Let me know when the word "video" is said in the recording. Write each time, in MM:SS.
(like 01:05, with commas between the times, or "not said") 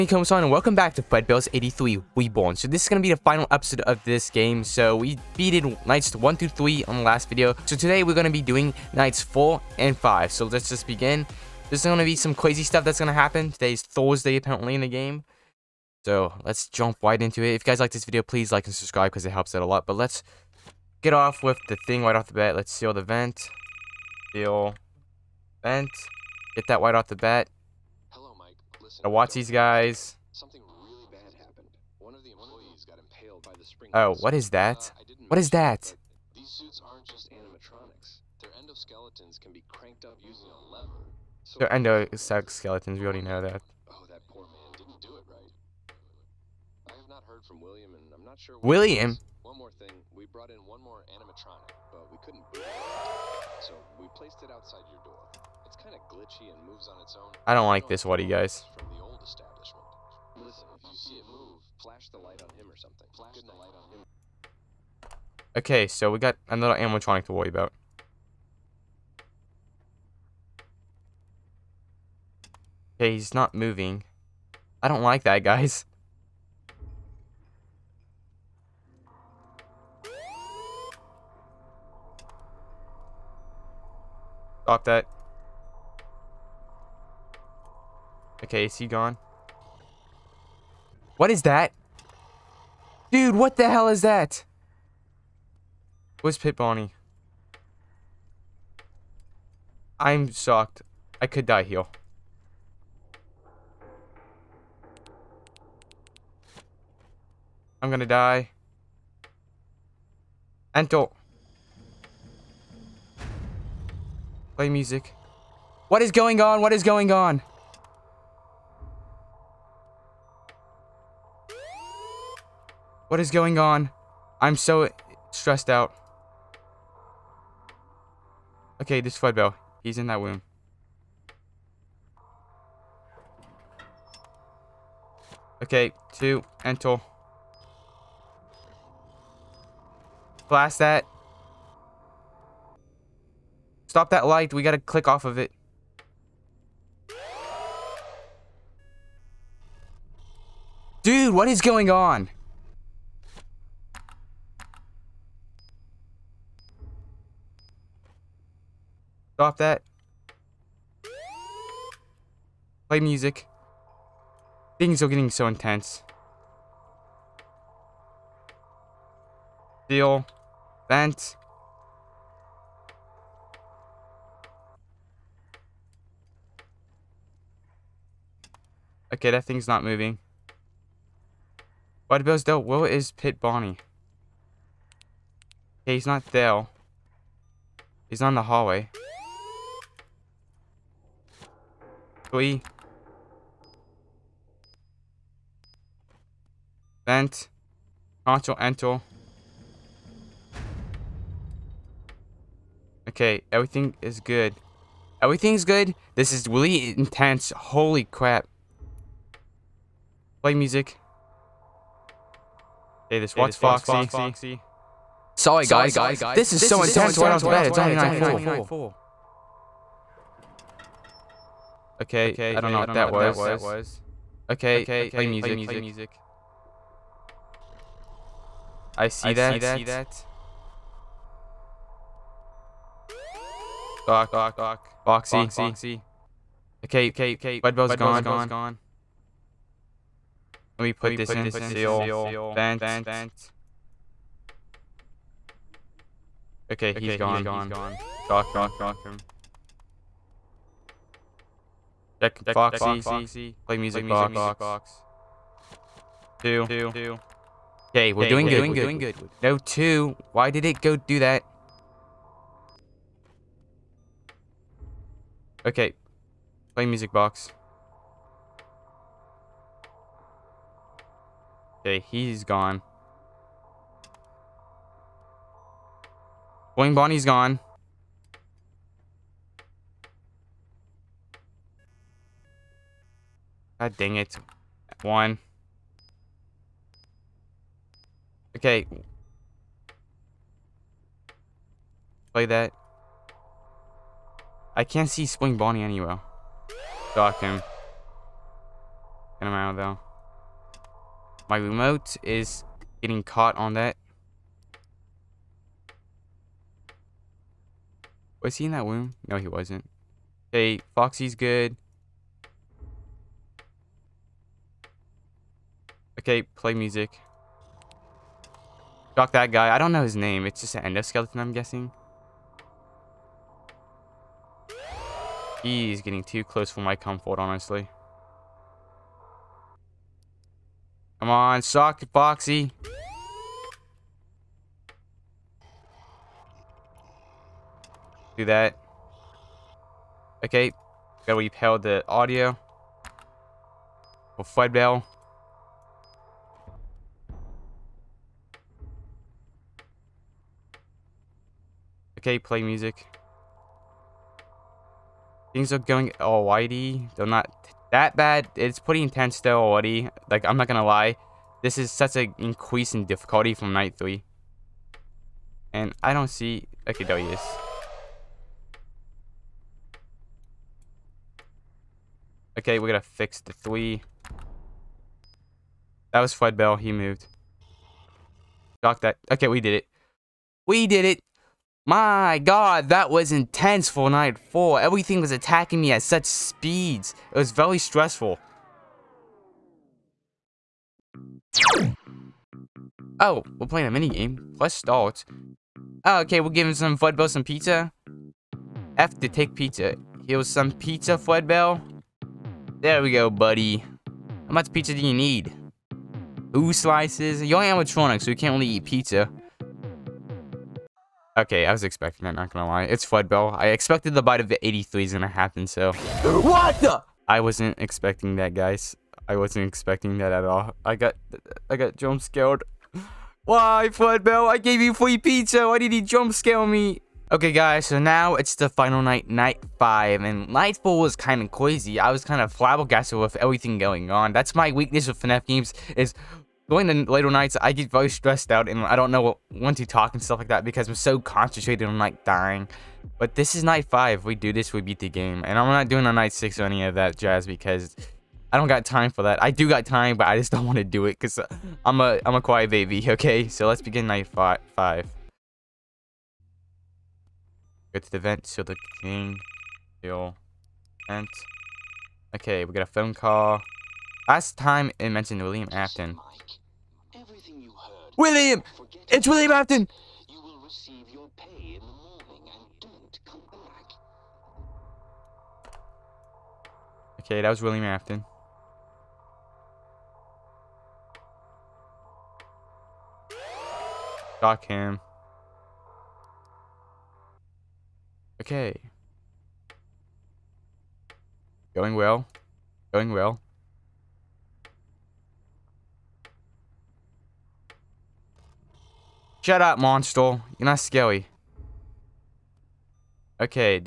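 00:07, 00:18.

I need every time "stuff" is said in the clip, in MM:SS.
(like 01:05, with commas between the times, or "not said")
00:12, 07:20.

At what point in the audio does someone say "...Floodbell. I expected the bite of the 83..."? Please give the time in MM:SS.
06:53.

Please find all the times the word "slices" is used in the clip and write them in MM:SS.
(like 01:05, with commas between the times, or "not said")
06:46.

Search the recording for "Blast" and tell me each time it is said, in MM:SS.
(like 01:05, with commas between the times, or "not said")
02:20.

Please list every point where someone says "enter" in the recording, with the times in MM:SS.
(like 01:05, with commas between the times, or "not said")
01:50, 02:16, 03:18.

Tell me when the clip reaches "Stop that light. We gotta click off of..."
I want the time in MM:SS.
02:23.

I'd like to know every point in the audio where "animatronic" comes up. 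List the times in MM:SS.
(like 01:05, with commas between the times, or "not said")
00:37, 00:51, 01:06, 06:47.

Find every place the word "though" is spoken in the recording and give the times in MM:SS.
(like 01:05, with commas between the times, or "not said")
04:59, 05:59.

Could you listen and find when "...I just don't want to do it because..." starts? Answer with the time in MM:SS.
07:30.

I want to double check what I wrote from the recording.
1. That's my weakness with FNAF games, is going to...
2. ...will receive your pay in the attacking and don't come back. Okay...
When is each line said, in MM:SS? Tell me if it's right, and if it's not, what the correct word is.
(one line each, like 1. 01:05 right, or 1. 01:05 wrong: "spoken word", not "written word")
1. 07:14 right
2. 07:50 wrong: "morning", not "attacking".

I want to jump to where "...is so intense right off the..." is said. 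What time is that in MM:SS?
03:36.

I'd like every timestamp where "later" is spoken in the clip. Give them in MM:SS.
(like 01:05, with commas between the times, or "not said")
07:17.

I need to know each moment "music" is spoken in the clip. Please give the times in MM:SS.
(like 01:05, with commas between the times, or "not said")
01:54, 02:43, 03:30, 03:45, 04:13, 04:26, 05:16, 05:52.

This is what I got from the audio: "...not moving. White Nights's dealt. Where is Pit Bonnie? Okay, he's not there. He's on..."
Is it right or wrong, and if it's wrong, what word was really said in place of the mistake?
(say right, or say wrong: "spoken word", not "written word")
wrong: "Bill", not "Nights".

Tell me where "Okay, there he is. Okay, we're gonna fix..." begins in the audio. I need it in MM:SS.
06:06.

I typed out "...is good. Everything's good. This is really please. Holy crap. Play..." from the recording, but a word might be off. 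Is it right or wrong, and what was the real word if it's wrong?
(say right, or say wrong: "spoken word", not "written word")
wrong: "intense", not "please".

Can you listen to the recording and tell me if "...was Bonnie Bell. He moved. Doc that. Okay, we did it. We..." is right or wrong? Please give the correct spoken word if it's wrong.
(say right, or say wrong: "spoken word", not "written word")
wrong: "Fred", not "Bonnie".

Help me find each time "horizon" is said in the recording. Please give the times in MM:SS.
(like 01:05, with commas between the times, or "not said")
not said.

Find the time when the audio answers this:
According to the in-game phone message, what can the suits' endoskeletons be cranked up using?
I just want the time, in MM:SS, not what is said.
00:40.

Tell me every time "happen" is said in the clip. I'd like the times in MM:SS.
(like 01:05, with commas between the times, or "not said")
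00:13, 06:55.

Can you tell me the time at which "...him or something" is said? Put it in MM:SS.
01:02.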